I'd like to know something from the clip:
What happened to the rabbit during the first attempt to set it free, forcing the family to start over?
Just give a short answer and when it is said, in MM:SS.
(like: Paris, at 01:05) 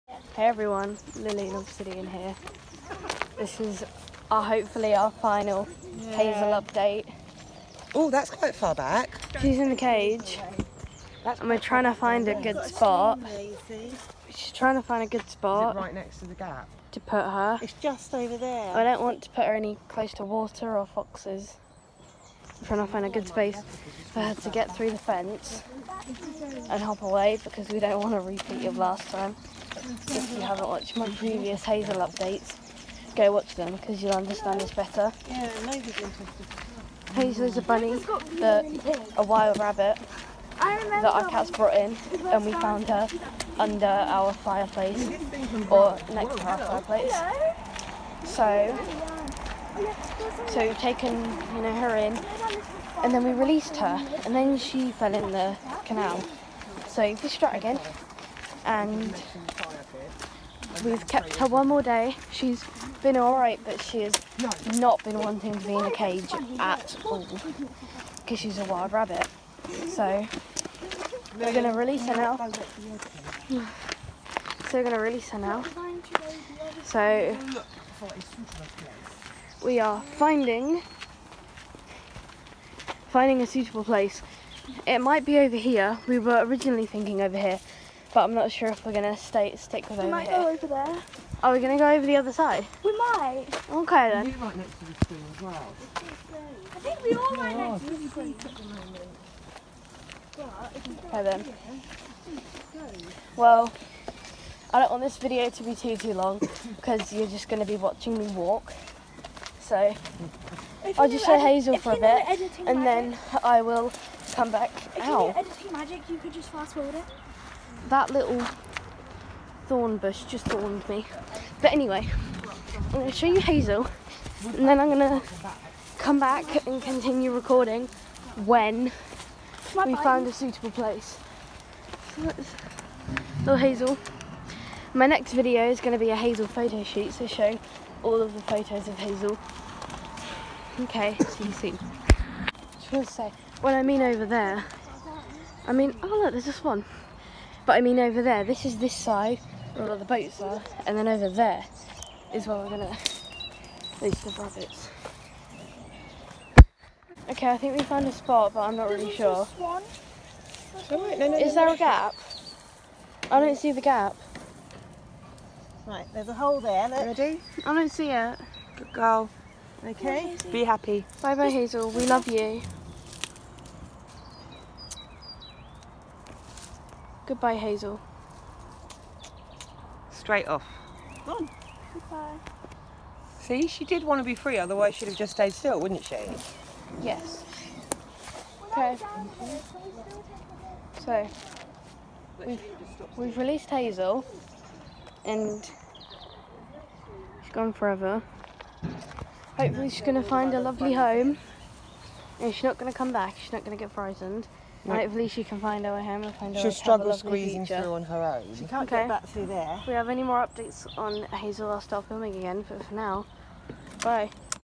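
She fell in the canal, at 00:54.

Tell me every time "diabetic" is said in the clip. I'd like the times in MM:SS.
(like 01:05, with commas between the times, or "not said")
not said.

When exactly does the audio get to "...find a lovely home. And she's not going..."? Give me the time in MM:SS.
03:20.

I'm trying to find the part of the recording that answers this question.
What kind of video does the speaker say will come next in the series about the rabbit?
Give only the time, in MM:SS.
02:16.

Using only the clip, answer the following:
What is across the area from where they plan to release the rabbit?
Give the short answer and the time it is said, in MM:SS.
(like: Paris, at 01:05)
Boats, at 02:30.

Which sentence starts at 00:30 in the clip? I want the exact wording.
If you haven't watched my previous Hazel updates, go watch them because you'll understand this better.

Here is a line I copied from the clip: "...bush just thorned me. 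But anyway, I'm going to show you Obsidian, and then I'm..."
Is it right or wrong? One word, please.
wrong.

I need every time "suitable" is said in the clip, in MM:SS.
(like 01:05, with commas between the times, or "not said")
01:23, 02:10.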